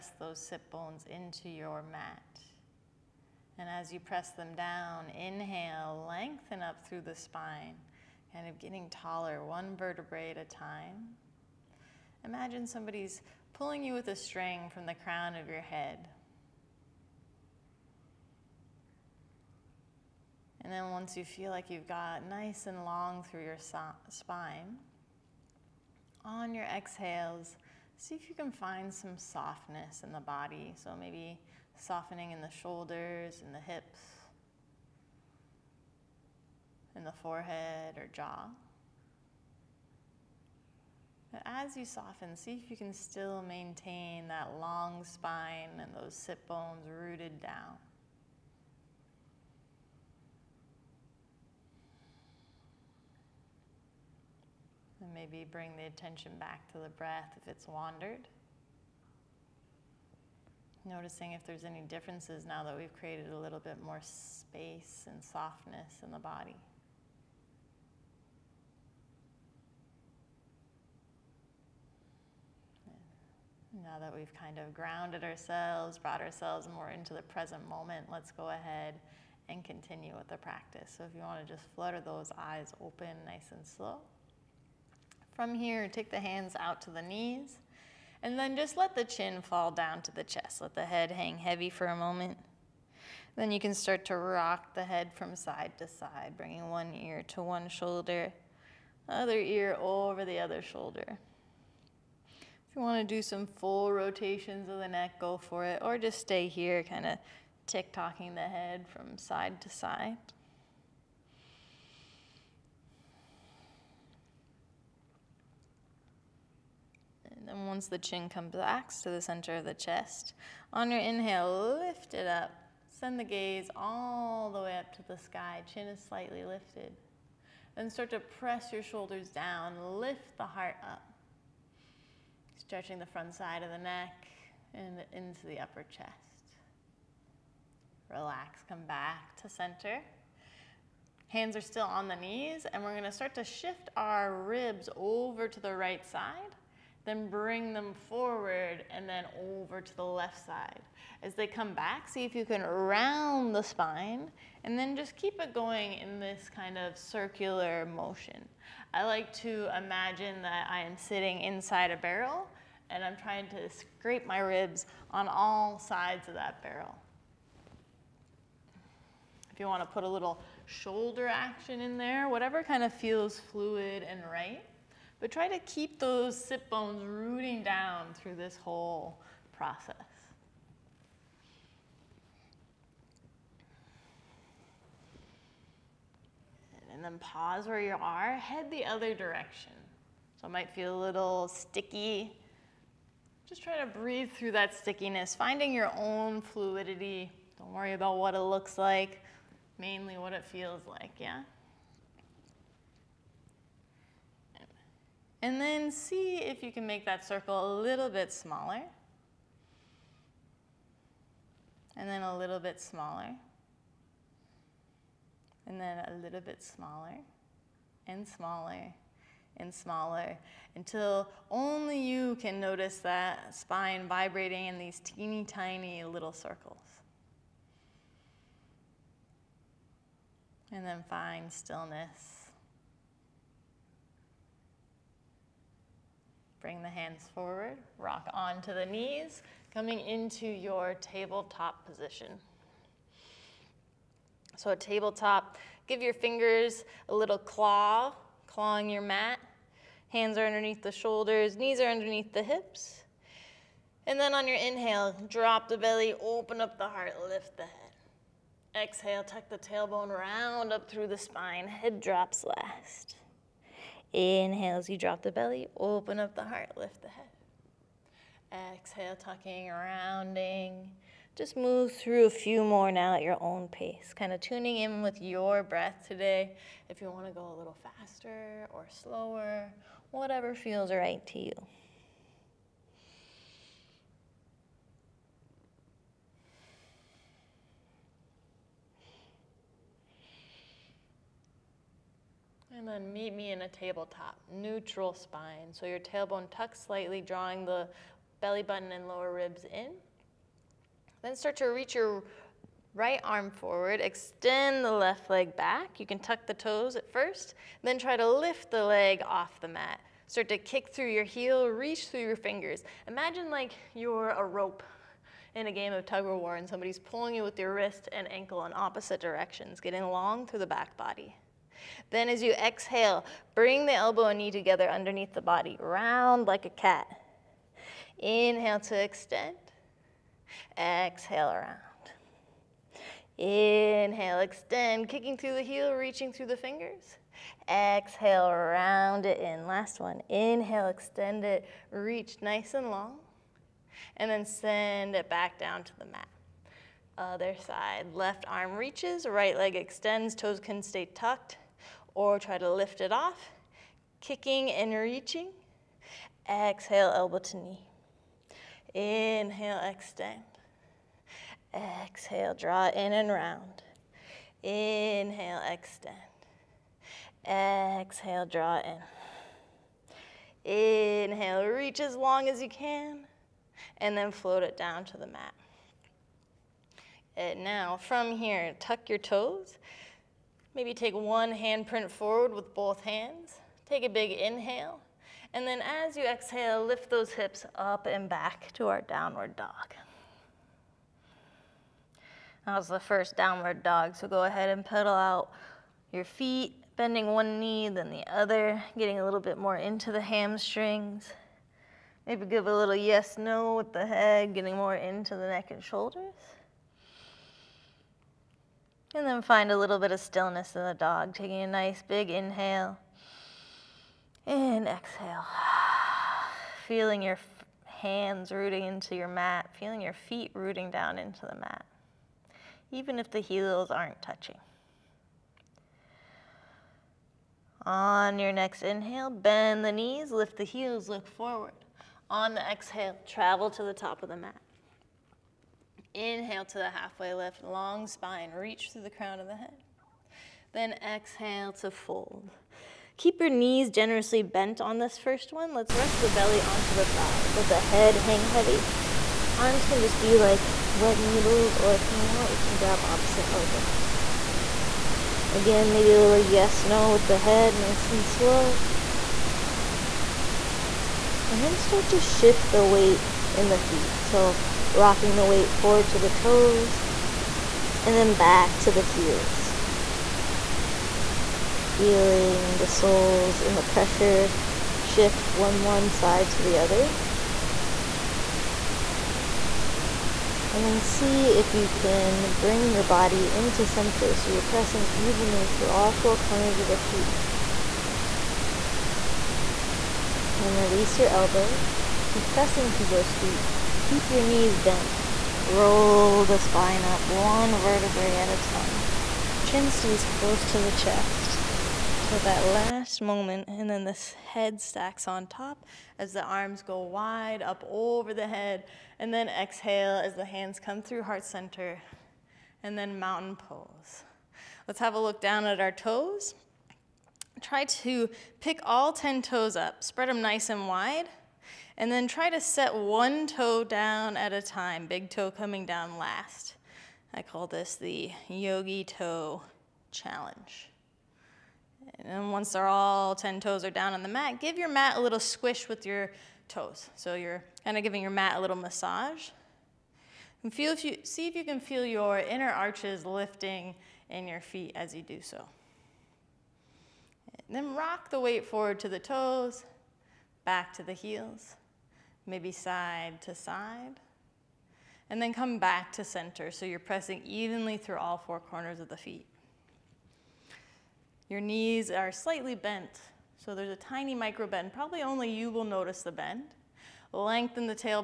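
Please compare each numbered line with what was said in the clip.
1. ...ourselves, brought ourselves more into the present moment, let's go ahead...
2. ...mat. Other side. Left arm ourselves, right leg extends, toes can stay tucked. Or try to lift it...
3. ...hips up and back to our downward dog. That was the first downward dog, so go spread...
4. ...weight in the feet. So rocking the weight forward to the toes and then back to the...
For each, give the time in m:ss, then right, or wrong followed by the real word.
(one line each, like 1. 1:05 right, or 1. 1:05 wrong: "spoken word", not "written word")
1. 1:15 right
2. 5:46 wrong: "reaches", not "ourselves"
3. 6:27 wrong: "ahead", not "spread"
4. 7:42 right.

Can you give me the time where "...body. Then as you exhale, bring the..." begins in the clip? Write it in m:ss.
5:20.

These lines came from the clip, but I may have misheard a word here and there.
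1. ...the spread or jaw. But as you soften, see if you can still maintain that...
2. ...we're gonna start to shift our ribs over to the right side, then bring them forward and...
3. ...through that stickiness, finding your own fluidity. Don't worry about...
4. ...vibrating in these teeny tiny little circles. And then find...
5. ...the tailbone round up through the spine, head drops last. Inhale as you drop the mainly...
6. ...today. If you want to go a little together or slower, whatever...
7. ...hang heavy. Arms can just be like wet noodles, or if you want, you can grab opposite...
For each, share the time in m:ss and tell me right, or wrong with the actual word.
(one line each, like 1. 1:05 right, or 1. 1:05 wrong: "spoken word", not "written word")
1. 0:37 wrong: "forehead", not "spread"
2. 2:22 right
3. 3:14 right
4. 3:44 right
5. 4:19 wrong: "belly", not "mainly"
6. 4:36 wrong: "faster", not "together"
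7. 7:28 right.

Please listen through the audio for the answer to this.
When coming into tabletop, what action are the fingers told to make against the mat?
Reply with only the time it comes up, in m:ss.
4:07.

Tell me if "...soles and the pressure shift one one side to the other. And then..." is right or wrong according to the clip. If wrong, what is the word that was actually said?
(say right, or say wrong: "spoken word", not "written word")
right.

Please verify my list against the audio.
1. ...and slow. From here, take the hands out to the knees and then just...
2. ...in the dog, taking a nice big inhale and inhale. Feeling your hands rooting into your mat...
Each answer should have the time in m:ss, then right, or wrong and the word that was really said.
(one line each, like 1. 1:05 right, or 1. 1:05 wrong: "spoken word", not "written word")
1. 1:23 right
2. 6:50 wrong: "exhale", not "inhale".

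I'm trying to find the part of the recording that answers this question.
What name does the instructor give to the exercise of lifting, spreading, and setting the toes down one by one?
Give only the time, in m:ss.
8:48.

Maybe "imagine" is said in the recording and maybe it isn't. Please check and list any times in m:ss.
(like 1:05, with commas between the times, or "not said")
0:12, 2:39, 5:13.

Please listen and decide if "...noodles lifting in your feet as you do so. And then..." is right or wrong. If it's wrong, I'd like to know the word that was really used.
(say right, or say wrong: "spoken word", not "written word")
wrong: "arches", not "noodles".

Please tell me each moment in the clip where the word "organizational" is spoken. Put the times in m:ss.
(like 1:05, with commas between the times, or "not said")
not said.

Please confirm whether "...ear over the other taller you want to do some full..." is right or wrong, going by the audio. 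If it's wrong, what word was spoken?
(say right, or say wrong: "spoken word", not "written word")
wrong: "shoulder", not "taller".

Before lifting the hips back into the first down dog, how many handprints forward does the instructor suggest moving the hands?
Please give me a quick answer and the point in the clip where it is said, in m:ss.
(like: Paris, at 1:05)
1, at 6:21.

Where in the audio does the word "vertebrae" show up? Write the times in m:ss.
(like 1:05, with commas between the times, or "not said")
0:09, 8:17.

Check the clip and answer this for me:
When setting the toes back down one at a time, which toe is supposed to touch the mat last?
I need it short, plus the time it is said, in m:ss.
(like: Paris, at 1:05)
big toe, at 8:45.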